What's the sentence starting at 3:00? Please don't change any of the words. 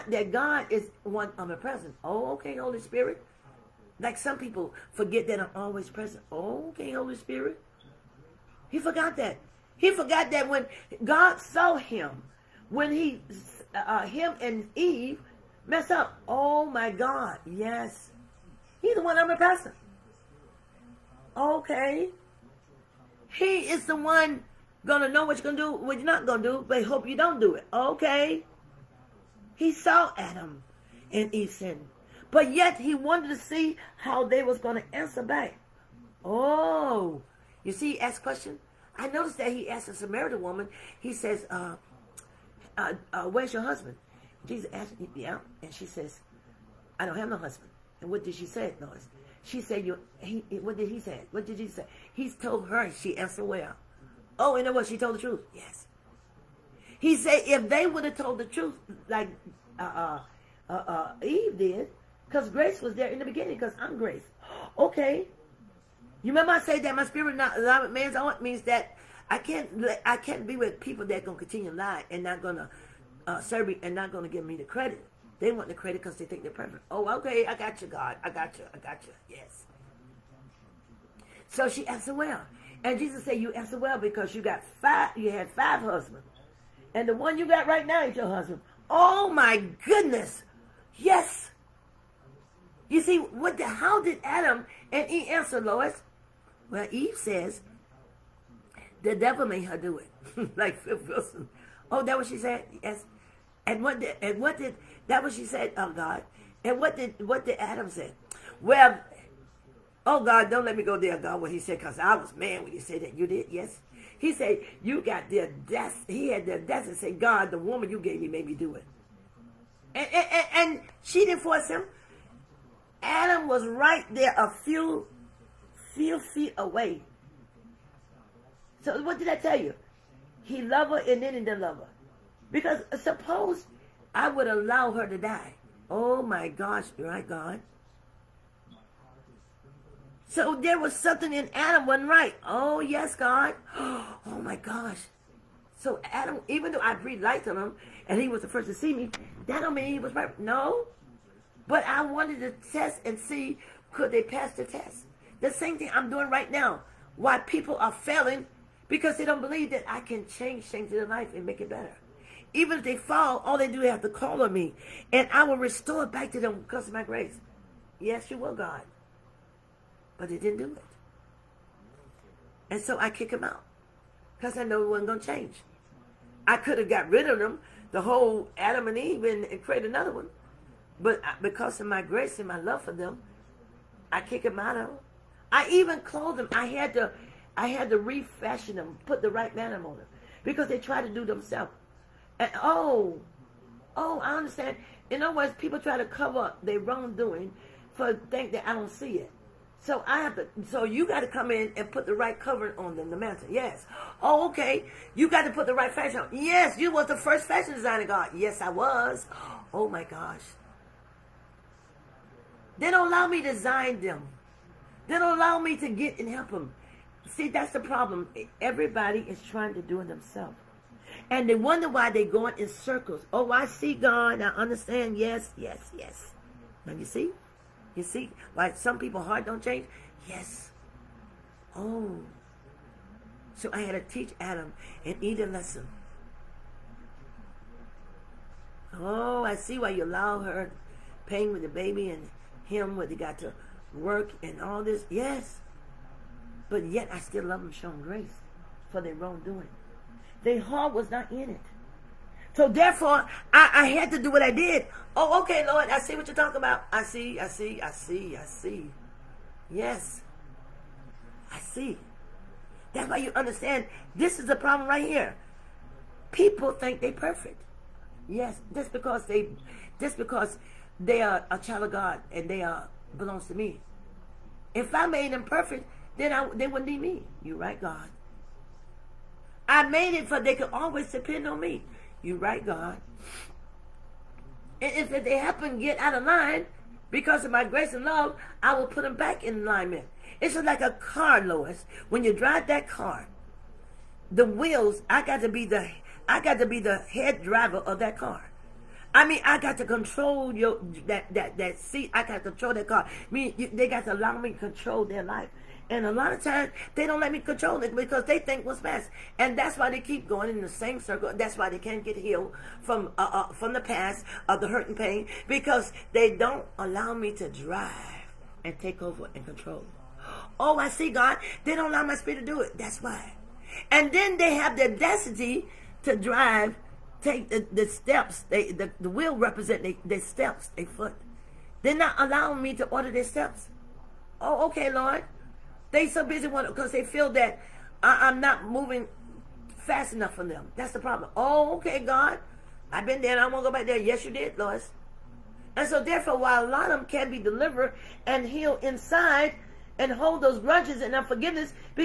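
But because of my grace and my love for them, I kick them out of them.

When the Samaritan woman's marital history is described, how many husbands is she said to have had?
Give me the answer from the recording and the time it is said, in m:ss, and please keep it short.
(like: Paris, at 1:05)
5, at 1:25.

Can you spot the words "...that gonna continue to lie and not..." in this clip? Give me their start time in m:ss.
1:11.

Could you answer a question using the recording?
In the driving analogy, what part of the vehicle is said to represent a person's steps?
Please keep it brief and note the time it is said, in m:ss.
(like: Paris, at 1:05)
the wheel, at 5:28.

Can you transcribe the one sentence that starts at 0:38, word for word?
I noticed that he asked a Samaritan woman.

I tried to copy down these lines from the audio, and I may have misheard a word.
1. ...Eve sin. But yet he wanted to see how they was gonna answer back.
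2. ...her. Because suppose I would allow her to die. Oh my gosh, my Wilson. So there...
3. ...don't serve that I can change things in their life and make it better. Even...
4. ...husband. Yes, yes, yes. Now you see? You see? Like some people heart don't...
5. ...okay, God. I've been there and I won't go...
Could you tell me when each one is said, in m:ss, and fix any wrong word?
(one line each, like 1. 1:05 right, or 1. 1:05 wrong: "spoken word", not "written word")
1. 0:31 right
2. 2:11 wrong: "God", not "Wilson"
3. 2:39 wrong: "believe", not "serve"
4. 3:44 wrong: "understand", not "husband"
5. 5:41 right.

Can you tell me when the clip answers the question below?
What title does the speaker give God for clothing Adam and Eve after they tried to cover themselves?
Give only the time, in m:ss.
3:27.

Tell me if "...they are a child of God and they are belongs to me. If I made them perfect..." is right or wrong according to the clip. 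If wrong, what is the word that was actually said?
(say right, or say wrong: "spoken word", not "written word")
right.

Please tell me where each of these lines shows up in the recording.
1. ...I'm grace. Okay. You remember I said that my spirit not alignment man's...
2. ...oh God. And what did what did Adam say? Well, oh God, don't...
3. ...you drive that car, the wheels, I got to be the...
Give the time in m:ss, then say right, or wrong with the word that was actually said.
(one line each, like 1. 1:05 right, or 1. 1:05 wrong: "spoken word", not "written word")
1. 1:03 right
2. 1:45 right
3. 4:52 right.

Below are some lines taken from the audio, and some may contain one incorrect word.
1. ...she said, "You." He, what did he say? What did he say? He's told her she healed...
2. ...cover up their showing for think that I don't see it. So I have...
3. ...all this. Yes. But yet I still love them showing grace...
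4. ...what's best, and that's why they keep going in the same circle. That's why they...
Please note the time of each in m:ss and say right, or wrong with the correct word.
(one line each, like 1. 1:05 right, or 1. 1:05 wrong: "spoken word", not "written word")
1. 0:49 wrong: "answered", not "healed"
2. 3:16 wrong: "wrongdoing", not "showing"
3. 4:04 right
4. 5:08 right.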